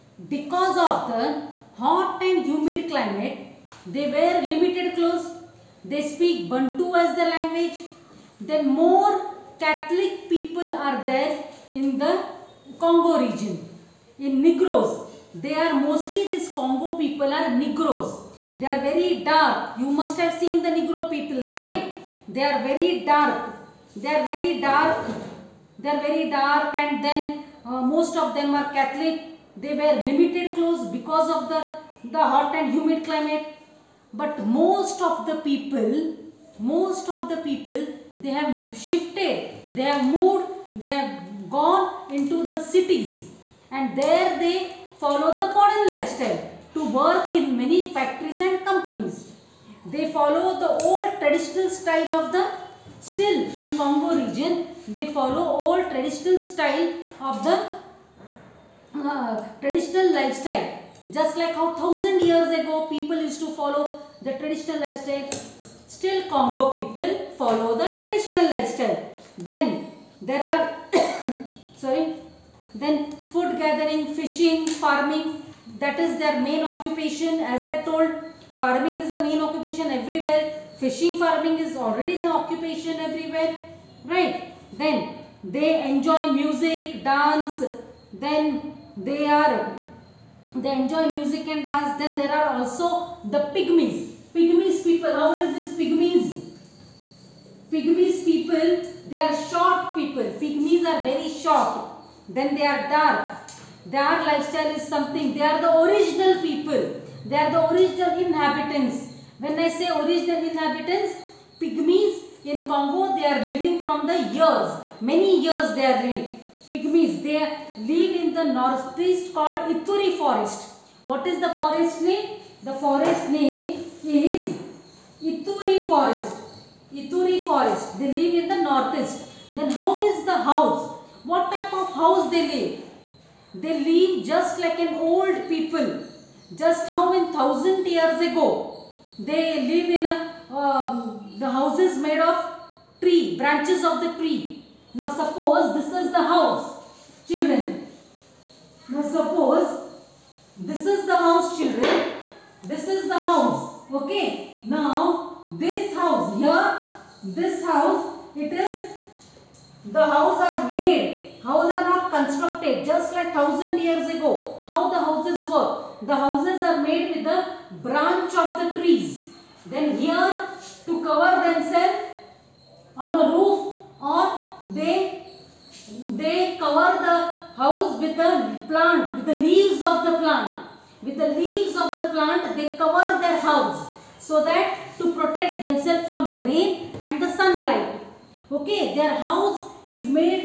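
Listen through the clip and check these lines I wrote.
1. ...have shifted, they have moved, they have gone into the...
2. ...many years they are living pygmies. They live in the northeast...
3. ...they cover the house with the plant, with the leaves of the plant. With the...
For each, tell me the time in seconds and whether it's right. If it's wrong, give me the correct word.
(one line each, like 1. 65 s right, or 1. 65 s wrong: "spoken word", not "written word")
1. 38 s right
2. 115 s right
3. 176 s right.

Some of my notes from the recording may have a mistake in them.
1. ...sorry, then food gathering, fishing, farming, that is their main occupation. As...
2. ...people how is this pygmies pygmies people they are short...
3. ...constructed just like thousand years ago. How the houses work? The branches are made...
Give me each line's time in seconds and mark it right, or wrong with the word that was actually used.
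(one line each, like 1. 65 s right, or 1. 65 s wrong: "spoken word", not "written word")
1. 71 s right
2. 94 s right
3. 162 s wrong: "houses", not "branches".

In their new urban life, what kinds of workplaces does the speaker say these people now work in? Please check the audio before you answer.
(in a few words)
factories and companies.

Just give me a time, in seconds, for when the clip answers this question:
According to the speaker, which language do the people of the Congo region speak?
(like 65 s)
6 s.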